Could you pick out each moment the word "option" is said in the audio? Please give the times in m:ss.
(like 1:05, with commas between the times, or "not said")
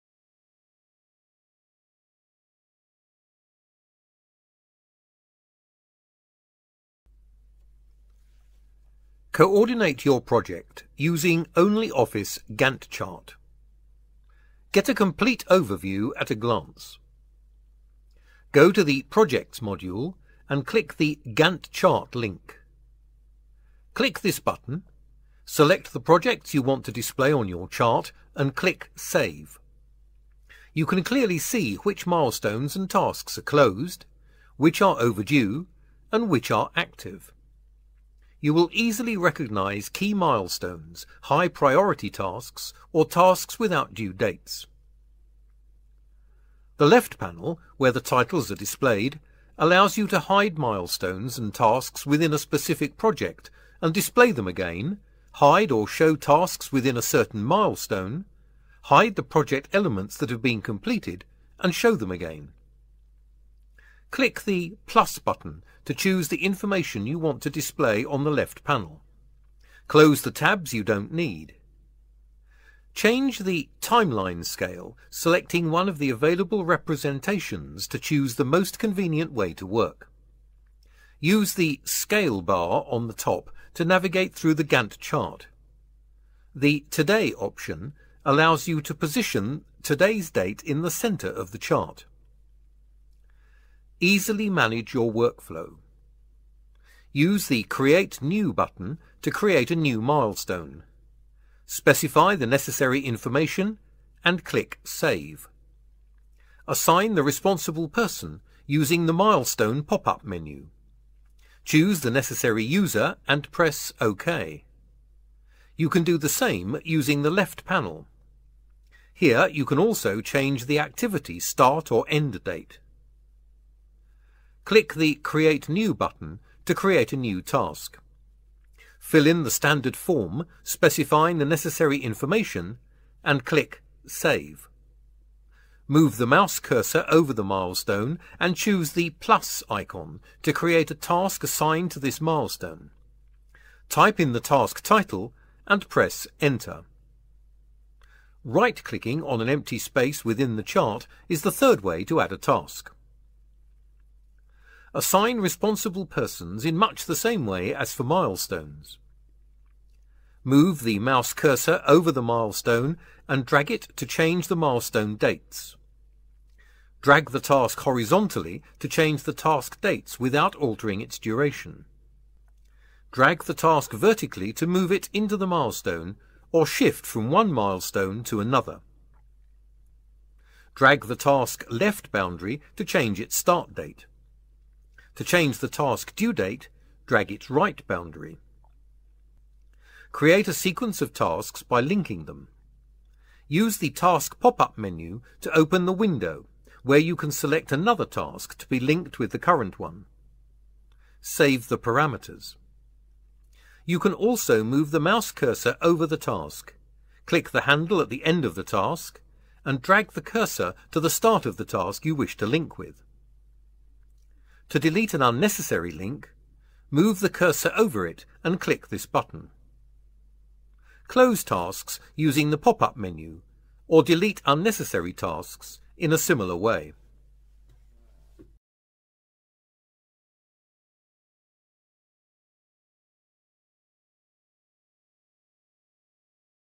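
1:27.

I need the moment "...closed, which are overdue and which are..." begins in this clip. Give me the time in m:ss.
0:33.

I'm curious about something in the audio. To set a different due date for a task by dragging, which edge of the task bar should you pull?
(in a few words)
right boundary.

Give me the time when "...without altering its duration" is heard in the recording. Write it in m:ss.
2:50.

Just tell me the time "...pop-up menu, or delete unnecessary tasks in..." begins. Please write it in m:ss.
3:42.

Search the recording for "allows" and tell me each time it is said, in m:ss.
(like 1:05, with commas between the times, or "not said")
0:49, 1:28.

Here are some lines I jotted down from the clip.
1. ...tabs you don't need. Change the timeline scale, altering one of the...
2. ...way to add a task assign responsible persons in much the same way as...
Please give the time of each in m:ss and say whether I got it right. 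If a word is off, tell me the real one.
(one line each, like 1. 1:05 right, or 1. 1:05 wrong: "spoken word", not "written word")
1. 1:10 wrong: "selecting", not "altering"
2. 2:31 right.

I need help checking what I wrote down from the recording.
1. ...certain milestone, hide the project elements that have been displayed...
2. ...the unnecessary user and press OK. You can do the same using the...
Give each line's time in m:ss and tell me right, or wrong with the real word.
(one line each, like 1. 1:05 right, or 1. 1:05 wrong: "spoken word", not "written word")
1. 0:57 wrong: "completed", not "displayed"
2. 1:52 wrong: "necessary", not "unnecessary".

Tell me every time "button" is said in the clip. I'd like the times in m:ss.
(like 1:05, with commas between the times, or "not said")
0:24, 1:05, 1:38, 2:05, 3:39.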